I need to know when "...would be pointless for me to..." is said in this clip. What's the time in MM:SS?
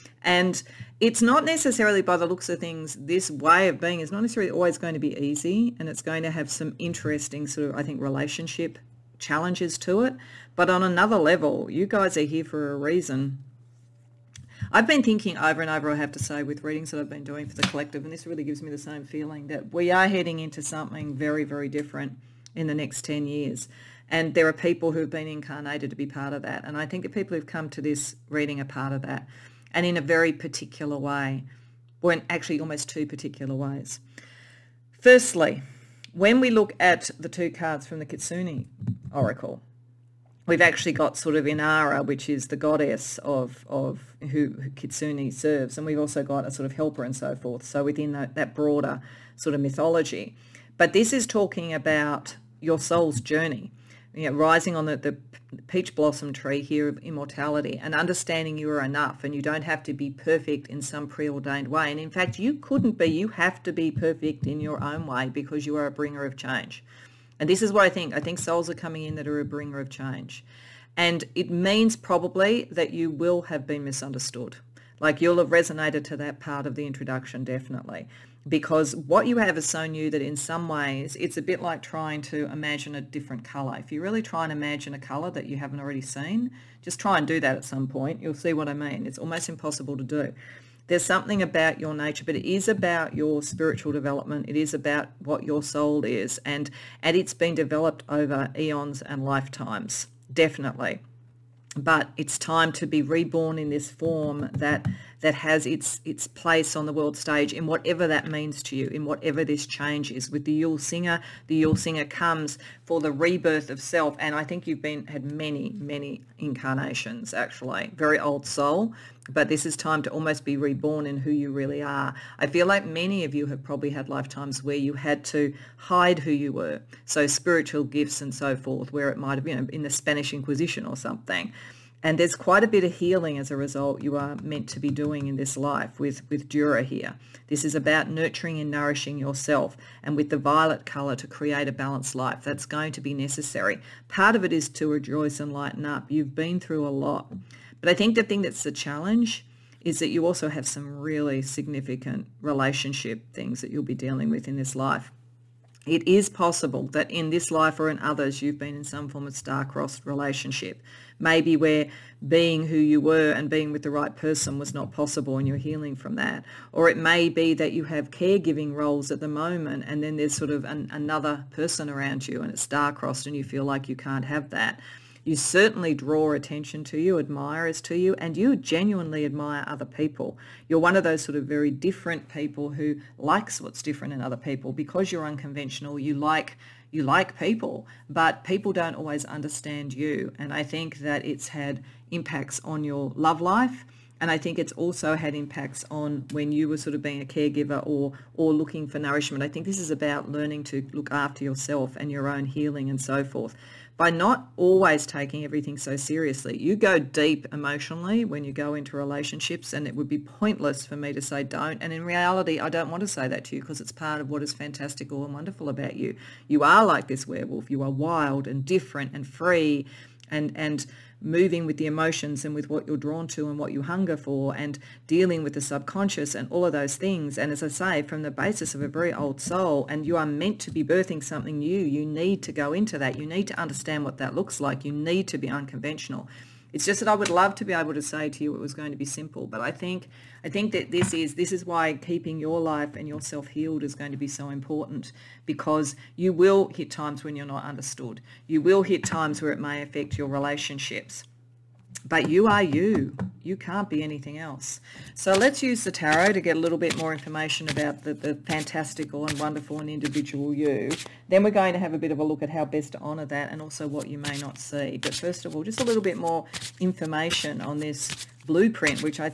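03:29.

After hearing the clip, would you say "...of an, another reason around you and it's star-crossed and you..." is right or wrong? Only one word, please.
wrong.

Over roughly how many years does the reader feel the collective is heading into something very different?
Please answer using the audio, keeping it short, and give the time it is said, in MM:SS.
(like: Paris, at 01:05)
10 years, at 00:23.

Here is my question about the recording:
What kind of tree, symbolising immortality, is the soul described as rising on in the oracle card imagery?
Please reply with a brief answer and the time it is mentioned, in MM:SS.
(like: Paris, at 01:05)
peach blossom tree, at 00:55.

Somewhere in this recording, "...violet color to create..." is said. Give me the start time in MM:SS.
02:20.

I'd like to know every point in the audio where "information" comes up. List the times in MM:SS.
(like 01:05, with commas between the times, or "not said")
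04:17, 04:26.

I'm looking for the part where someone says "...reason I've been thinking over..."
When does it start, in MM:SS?
00:12.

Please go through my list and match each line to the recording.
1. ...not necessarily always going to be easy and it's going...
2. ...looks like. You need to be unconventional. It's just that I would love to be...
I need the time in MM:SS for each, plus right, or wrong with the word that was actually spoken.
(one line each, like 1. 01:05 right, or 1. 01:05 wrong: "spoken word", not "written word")
1. 00:04 right
2. 03:54 right.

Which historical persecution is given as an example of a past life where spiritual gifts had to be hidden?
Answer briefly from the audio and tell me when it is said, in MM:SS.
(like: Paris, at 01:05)
Spanish Inquisition, at 02:09.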